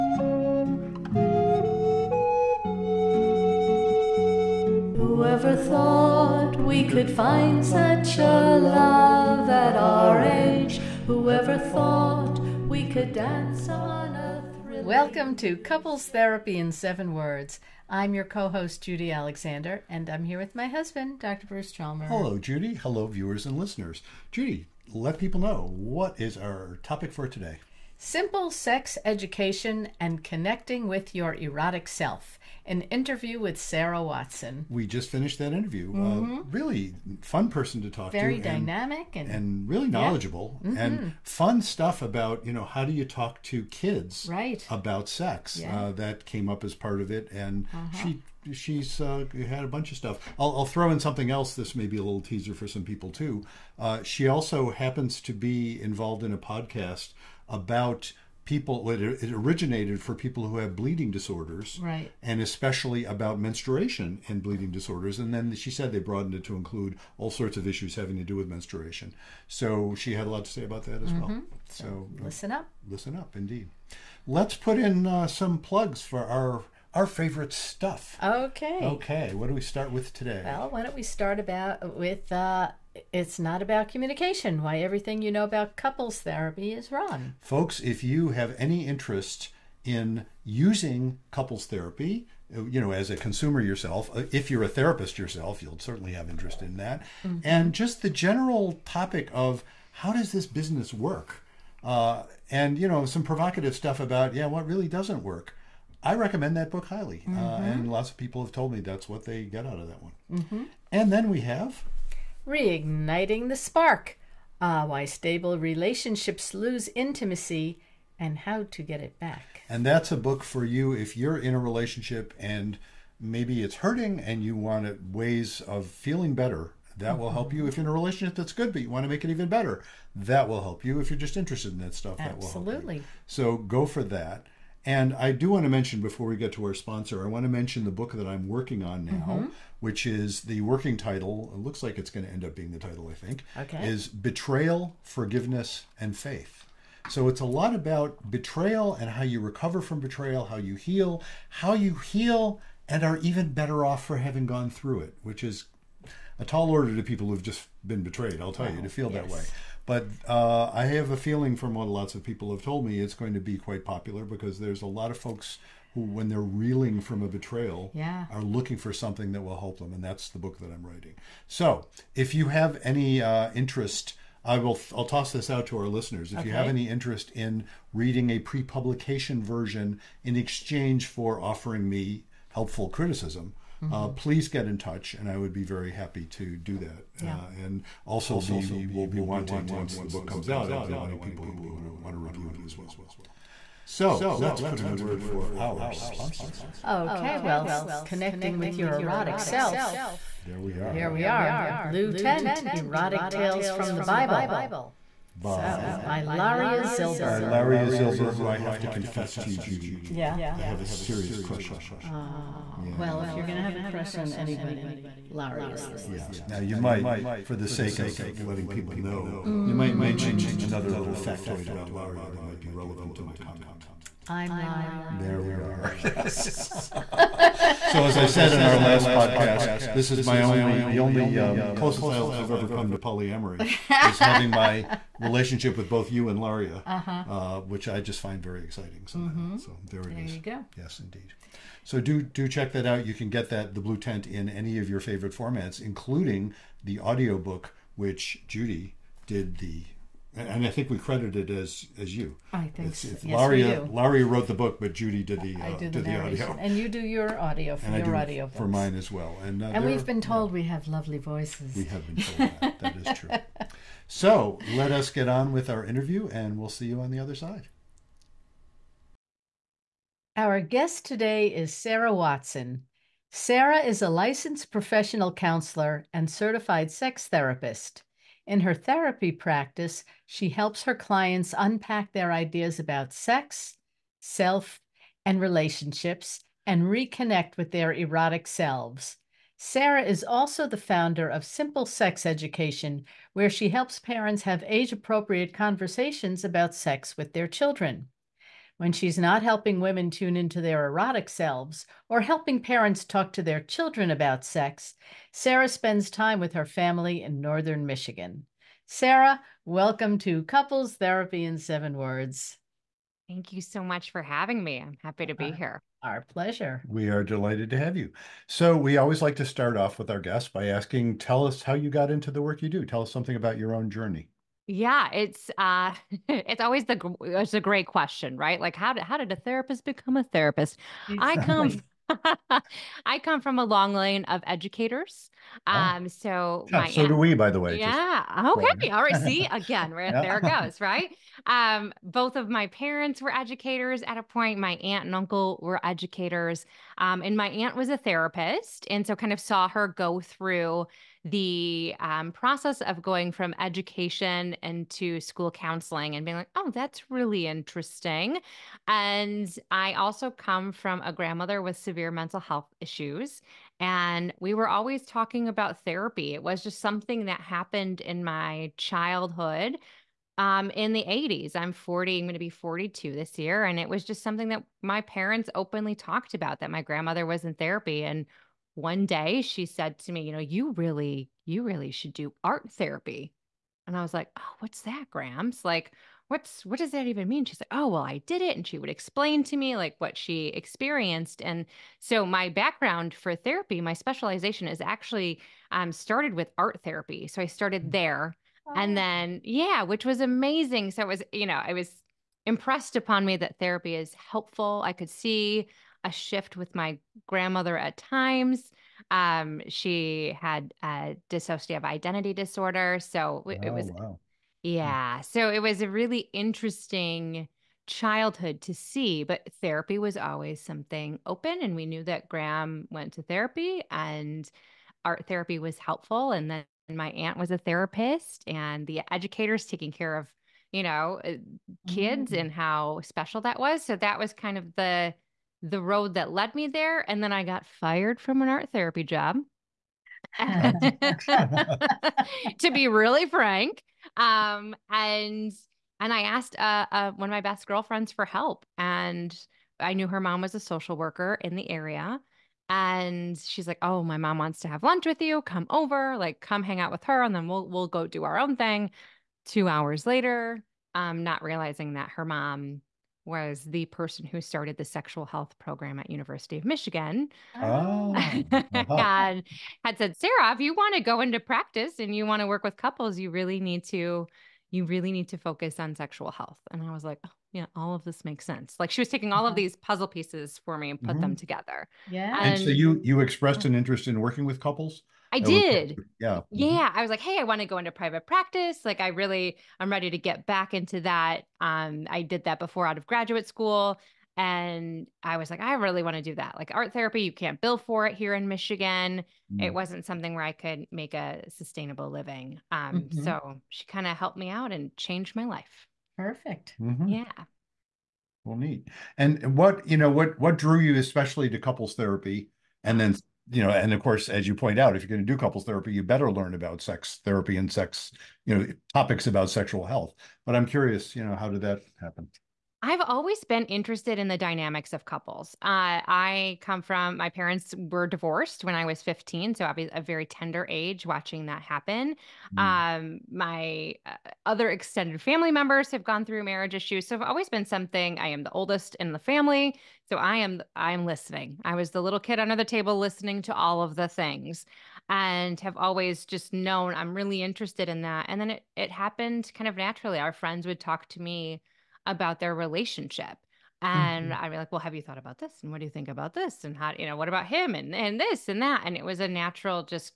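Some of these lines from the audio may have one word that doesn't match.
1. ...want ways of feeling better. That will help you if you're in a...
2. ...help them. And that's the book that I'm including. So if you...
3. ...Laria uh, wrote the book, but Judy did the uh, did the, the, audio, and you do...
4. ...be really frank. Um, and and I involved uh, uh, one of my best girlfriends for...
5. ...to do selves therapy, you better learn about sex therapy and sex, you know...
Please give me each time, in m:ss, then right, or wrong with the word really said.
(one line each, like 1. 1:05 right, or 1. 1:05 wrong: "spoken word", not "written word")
1. 2:04 right
2. 2:49 wrong: "writing", not "including"
3. 4:13 right
4. 7:22 wrong: "asked", not "involved"
5. 8:35 wrong: "couples", not "selves".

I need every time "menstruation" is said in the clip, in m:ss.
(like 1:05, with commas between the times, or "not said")
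1:03, 1:08.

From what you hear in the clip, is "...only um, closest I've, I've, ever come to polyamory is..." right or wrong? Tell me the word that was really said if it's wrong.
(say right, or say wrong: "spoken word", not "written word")
right.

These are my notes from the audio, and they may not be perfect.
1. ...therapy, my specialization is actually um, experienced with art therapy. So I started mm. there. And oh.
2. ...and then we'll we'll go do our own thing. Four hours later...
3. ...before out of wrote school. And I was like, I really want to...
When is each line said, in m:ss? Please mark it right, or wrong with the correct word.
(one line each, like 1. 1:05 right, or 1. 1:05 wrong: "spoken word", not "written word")
1. 6:33 wrong: "started", not "experienced"
2. 7:37 wrong: "Two", not "Four"
3. 8:12 wrong: "graduate", not "wrote".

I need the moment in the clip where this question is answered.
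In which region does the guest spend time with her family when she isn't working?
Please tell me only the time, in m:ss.
5:07.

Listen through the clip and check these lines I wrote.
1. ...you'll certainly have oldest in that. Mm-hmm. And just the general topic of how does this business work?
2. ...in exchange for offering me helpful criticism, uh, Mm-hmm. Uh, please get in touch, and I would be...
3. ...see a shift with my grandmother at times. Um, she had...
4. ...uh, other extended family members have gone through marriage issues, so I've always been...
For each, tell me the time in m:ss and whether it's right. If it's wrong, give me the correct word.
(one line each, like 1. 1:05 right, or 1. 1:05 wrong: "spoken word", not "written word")
1. 1:35 wrong: "interest", not "oldest"
2. 3:00 right
3. 6:45 right
4. 8:54 right.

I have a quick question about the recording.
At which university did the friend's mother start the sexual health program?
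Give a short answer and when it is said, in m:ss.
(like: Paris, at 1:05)
University of Michigan, at 7:46.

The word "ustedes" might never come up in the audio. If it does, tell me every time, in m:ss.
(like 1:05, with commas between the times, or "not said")
not said.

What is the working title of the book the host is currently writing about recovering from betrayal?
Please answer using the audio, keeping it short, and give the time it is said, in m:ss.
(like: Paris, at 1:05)
Betrayal, Forgiveness, and Faith, at 2:24.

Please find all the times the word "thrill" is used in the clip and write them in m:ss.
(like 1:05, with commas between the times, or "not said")
0:14.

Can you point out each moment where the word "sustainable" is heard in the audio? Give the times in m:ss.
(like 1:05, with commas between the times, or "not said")
8:21.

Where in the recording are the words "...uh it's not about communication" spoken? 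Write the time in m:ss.
1:22.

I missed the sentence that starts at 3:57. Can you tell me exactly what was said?
uh, which I just find very exciting.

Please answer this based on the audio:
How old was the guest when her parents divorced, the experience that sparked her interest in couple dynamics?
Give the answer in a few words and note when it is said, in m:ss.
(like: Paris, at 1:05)
15, at 8:49.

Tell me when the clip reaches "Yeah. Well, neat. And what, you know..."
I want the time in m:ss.
8:27.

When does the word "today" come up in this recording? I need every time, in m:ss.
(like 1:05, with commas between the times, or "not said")
0:27, 1:20, 4:31.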